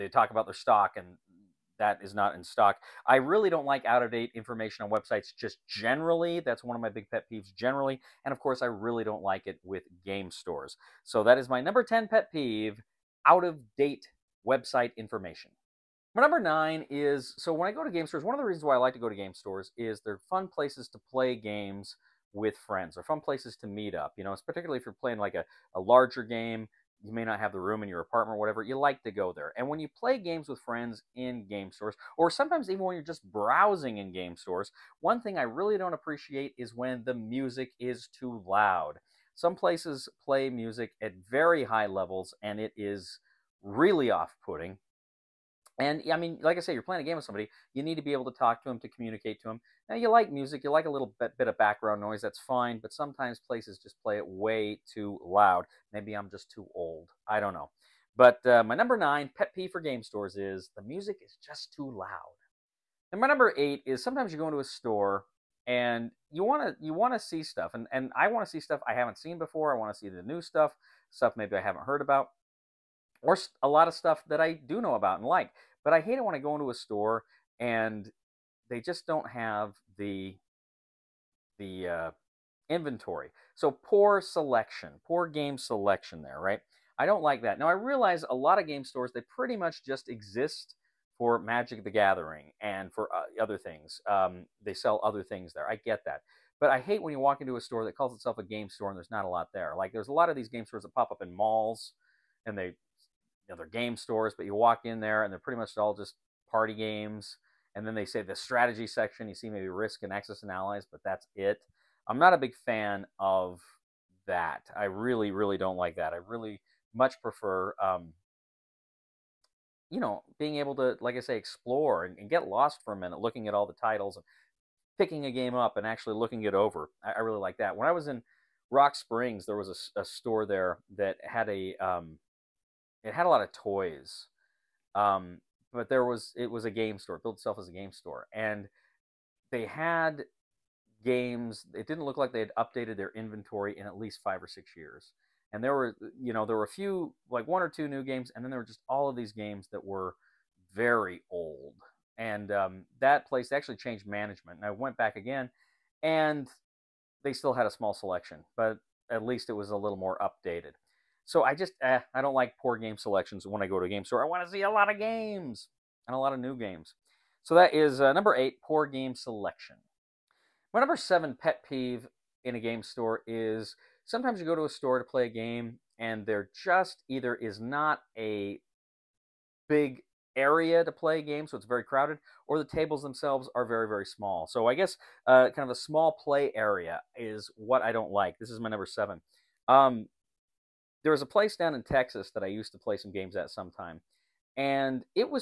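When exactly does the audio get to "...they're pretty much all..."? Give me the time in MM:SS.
01:45.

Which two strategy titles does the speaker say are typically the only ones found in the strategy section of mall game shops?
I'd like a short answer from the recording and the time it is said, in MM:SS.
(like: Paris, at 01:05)
Risk and Axis and Allies, at 01:49.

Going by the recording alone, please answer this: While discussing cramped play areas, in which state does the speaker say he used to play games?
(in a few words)
Texas.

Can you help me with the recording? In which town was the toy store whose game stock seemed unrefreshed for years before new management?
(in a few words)
Rock Springs.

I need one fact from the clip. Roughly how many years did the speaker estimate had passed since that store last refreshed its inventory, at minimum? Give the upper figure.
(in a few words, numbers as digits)
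6.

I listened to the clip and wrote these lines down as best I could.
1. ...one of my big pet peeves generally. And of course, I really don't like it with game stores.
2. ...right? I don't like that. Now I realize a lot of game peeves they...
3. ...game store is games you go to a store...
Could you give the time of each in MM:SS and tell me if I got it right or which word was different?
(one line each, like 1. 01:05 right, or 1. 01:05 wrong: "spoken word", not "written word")
1. 00:06 right
2. 01:26 wrong: "stores", not "peeves"
3. 02:52 wrong: "sometimes", not "games".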